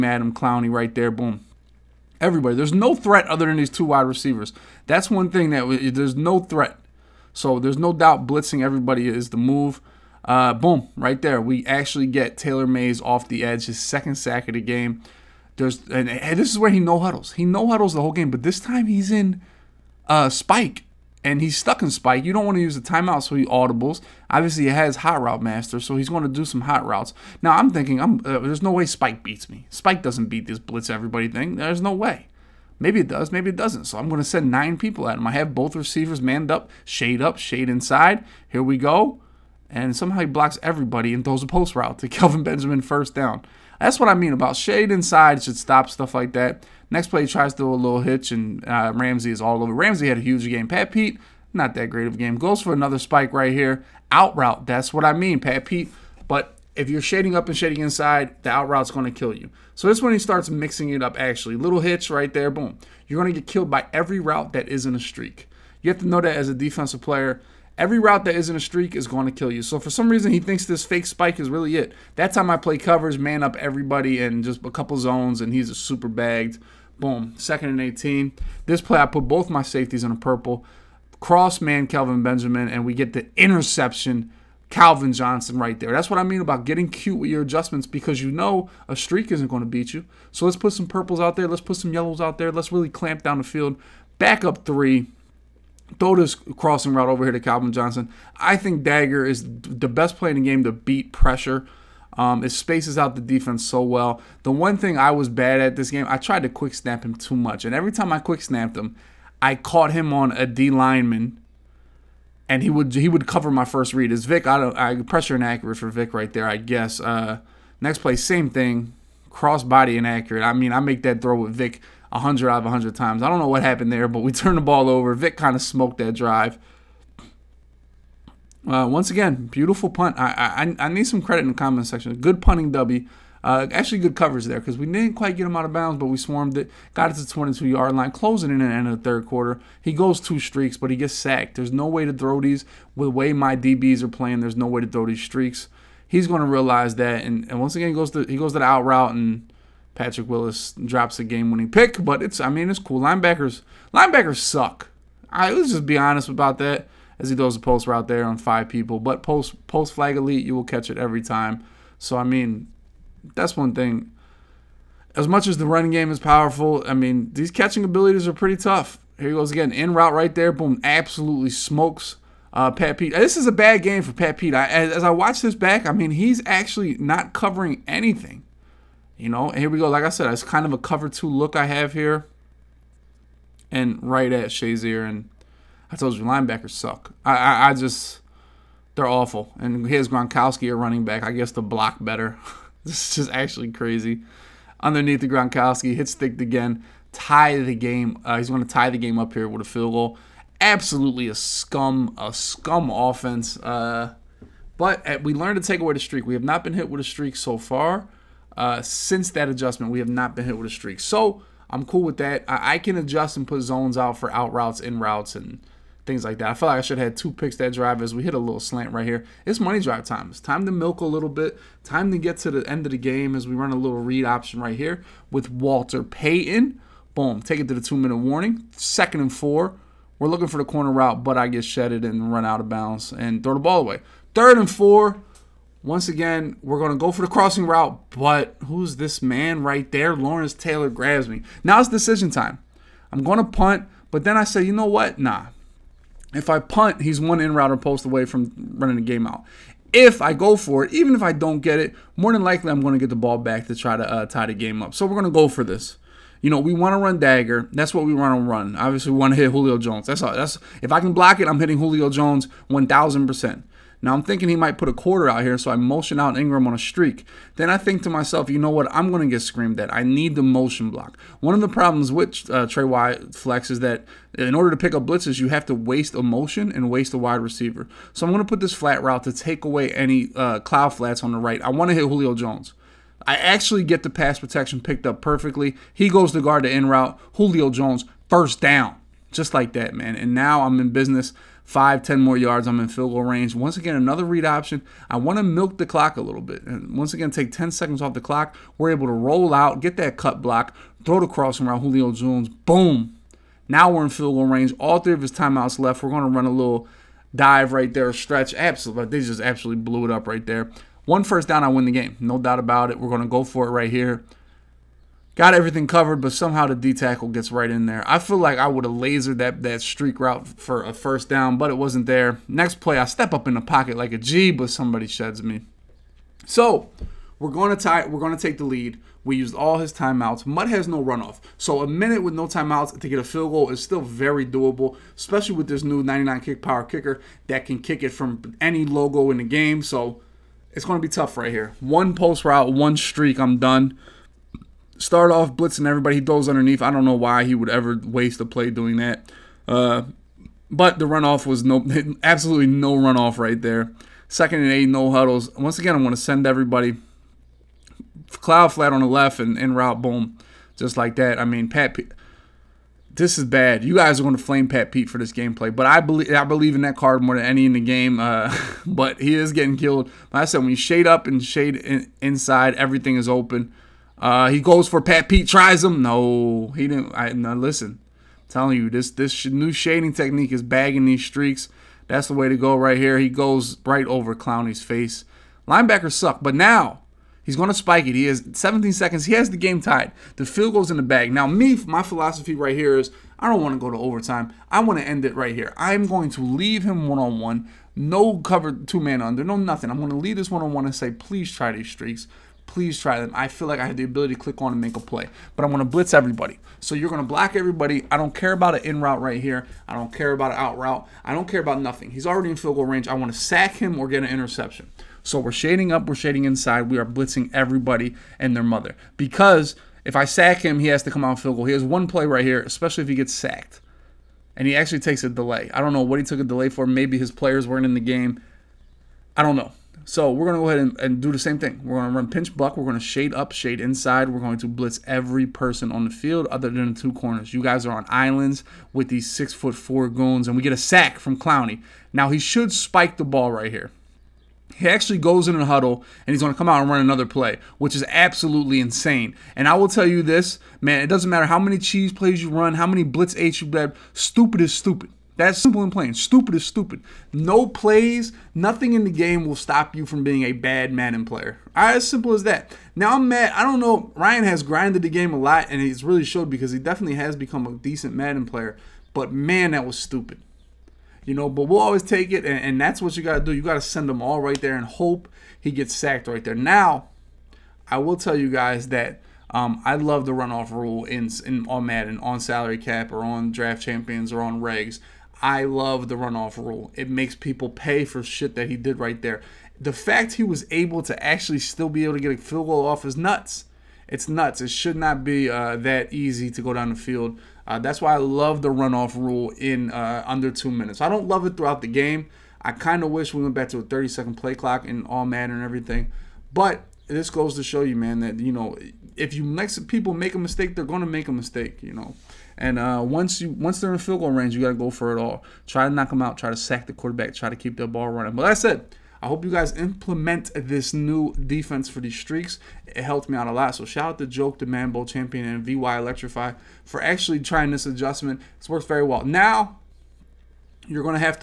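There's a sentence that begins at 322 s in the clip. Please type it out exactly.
Next play, I step up in the pocket like a G, but somebody sheds me.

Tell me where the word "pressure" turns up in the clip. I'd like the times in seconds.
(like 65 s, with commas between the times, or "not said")
101 s, 115 s.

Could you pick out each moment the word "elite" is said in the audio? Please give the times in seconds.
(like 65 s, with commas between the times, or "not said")
160 s.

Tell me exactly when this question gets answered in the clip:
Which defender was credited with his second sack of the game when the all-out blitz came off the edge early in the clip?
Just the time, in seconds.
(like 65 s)
12 s.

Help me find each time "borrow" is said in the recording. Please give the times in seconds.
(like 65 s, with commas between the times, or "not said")
not said.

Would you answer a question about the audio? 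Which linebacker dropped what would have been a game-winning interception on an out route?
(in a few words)
Patrick Willis.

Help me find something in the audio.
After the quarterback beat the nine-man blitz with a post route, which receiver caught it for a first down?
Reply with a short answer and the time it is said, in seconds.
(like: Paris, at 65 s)
Kelvin Benjamin, at 42 s.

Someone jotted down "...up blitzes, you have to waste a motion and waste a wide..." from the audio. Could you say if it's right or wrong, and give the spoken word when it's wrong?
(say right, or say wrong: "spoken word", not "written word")
right.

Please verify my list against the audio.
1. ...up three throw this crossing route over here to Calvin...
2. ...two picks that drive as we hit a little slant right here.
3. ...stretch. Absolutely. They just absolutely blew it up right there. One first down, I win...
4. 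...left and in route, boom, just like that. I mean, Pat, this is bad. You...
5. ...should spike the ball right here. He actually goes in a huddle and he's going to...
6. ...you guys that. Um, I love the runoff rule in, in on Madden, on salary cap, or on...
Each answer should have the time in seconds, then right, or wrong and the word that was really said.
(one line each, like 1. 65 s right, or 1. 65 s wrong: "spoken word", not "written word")
1. 94 s right
2. 217 s right
3. 308 s right
4. 359 s right
5. 442 s right
6. 478 s right.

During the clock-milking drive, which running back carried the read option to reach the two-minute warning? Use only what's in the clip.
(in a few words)
Walter Payton.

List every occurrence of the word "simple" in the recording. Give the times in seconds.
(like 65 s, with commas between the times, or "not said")
455 s, 462 s.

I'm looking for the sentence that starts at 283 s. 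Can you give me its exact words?
I actually get the pass protection picked up perfectly.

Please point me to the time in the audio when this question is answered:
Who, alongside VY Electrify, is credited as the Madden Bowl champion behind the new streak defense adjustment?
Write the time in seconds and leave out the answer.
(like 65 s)
524 s.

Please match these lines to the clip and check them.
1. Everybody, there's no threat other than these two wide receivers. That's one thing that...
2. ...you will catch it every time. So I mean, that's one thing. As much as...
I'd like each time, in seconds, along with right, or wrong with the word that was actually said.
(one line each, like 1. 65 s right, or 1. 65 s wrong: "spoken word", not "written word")
1. 2 s right
2. 160 s right.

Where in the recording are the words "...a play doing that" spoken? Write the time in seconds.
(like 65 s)
348 s.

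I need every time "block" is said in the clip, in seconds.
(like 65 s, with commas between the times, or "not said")
40 s, 191 s, 261 s, 270 s, 300 s, 407 s.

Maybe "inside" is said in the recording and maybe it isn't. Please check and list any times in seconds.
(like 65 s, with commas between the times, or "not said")
37 s, 44 s, 57 s, 372 s, 416 s, 433 s.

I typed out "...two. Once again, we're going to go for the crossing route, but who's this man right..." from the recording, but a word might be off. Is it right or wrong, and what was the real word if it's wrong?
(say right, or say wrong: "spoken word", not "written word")
wrong: "four", not "two".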